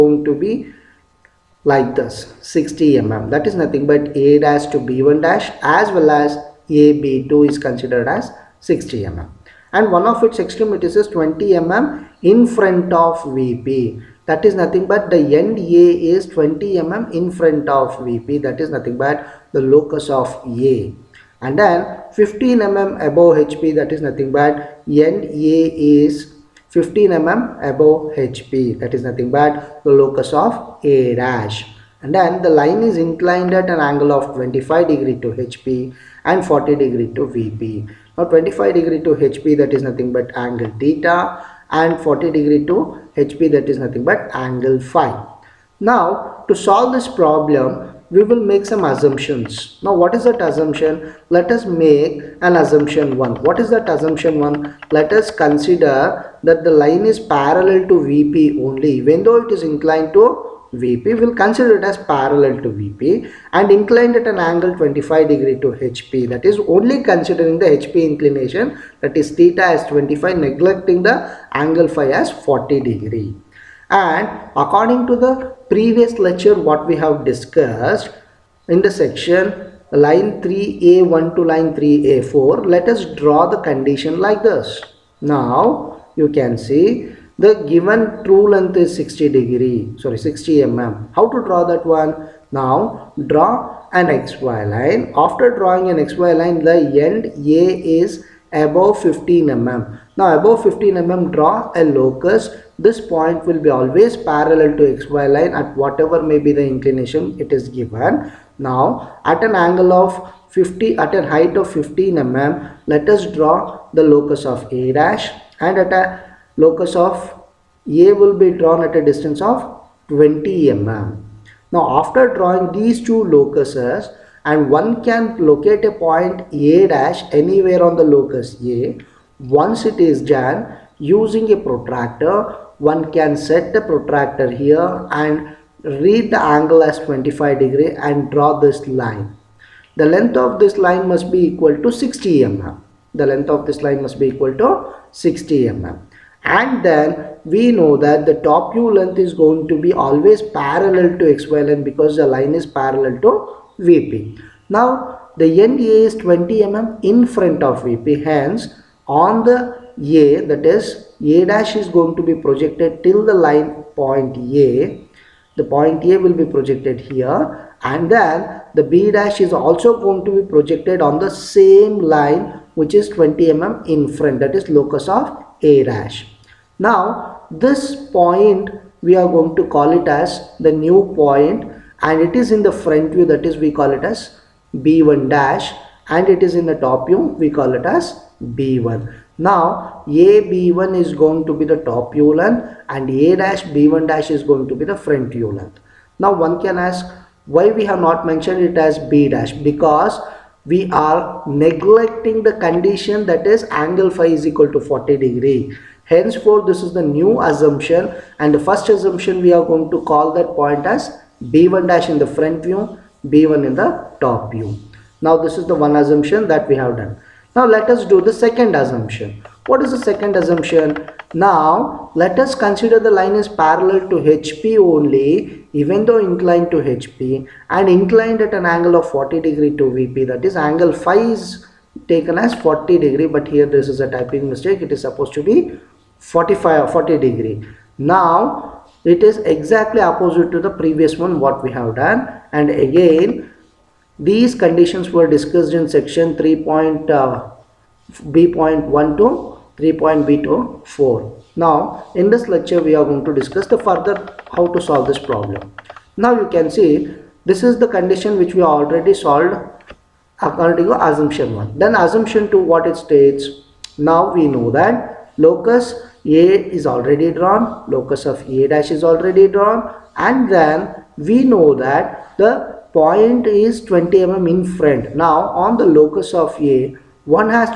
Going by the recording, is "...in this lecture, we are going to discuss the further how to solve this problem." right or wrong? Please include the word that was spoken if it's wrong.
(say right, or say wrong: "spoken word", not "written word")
right.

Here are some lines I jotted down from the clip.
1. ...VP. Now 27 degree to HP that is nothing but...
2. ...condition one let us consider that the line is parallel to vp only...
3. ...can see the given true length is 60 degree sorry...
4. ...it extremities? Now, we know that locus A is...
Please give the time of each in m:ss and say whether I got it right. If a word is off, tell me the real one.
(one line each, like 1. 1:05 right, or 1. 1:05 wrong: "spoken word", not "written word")
1. 0:37 wrong: "25", not "27"
2. 0:53 wrong: "assumption", not "condition"
3. 1:26 right
4. 4:22 wrong: "states", not "extremities".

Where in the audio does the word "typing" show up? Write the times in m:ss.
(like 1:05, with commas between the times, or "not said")
3:54.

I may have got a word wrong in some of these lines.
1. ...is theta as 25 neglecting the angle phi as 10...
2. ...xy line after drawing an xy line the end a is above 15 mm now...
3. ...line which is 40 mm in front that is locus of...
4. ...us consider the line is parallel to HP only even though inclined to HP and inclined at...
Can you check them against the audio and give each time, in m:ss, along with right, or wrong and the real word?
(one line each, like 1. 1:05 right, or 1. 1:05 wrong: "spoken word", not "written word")
1. 1:09 wrong: "40", not "10"
2. 1:34 right
3. 2:51 wrong: "20", not "40"
4. 3:42 right.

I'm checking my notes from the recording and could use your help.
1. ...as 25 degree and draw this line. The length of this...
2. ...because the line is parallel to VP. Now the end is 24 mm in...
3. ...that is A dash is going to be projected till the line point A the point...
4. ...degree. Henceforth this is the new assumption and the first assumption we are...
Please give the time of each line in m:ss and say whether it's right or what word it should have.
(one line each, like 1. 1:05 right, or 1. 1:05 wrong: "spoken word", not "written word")
1. 2:16 right
2. 2:31 wrong: "20", not "24"
3. 2:40 right
4. 3:25 right.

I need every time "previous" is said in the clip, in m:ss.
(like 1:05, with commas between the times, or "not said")
1:15, 4:00.